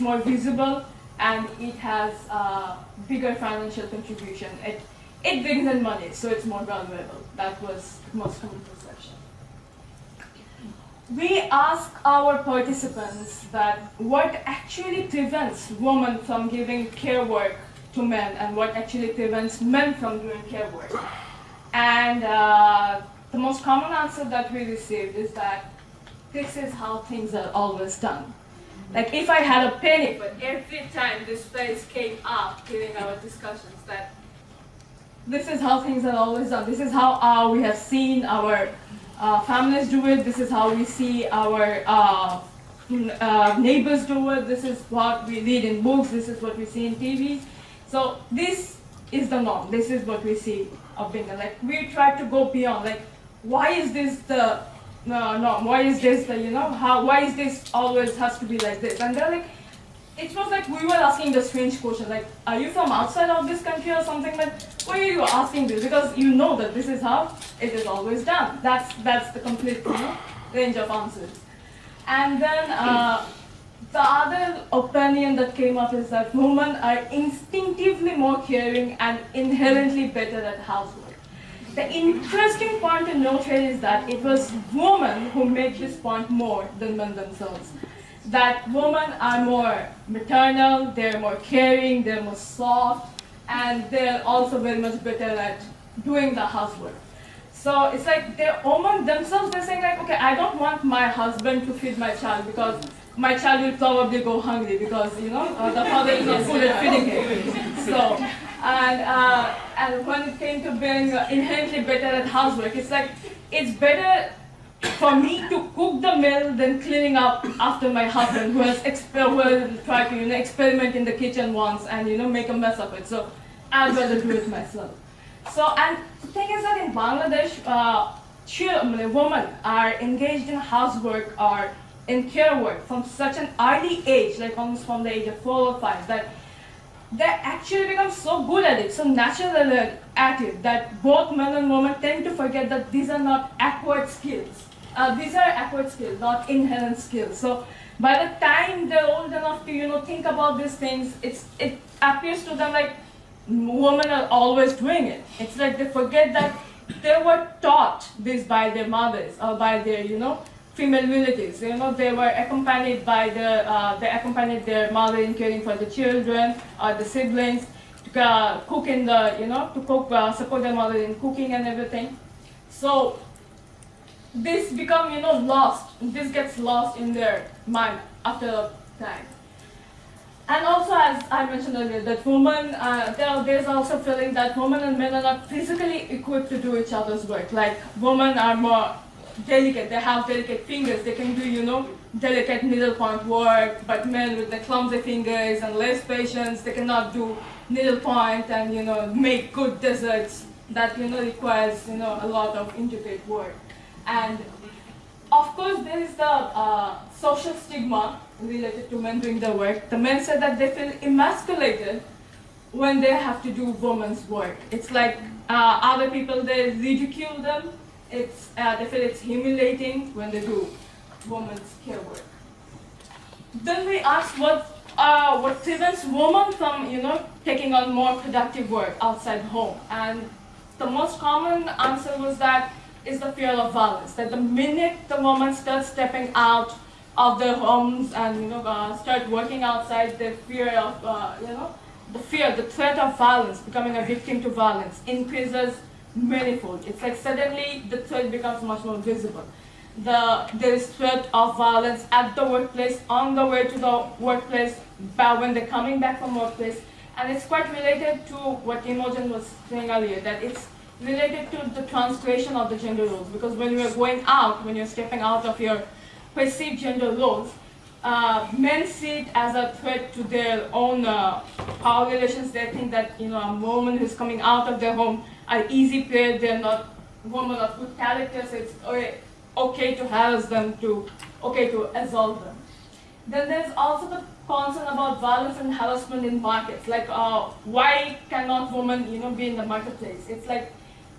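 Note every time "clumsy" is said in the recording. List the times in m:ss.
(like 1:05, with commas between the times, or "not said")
3:14.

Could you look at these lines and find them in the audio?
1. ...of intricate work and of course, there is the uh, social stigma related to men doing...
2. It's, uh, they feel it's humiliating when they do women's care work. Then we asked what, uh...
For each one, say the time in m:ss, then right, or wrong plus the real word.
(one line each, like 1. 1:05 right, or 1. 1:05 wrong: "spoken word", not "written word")
1. 3:22 right
2. 3:38 right.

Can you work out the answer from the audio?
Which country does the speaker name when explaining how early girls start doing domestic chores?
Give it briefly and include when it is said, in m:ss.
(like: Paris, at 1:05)
Bangladesh, at 2:06.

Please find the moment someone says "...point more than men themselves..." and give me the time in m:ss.
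1:25.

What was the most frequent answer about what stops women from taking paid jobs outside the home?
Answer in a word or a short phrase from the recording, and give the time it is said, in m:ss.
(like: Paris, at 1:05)
Fear of violence, at 3:53.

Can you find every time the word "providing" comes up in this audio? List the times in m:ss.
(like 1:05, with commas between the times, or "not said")
not said.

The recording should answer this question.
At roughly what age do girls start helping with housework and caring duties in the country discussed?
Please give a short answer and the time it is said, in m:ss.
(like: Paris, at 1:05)
4 or 5, at 2:15.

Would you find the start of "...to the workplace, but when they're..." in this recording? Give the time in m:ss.
4:13.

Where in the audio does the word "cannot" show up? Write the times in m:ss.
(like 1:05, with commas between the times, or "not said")
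3:16, 4:48.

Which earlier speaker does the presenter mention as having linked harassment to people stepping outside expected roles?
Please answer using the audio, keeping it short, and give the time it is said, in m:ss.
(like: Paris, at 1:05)
Imogen, at 4:18.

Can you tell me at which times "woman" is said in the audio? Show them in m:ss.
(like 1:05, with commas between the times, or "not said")
3:55, 4:33.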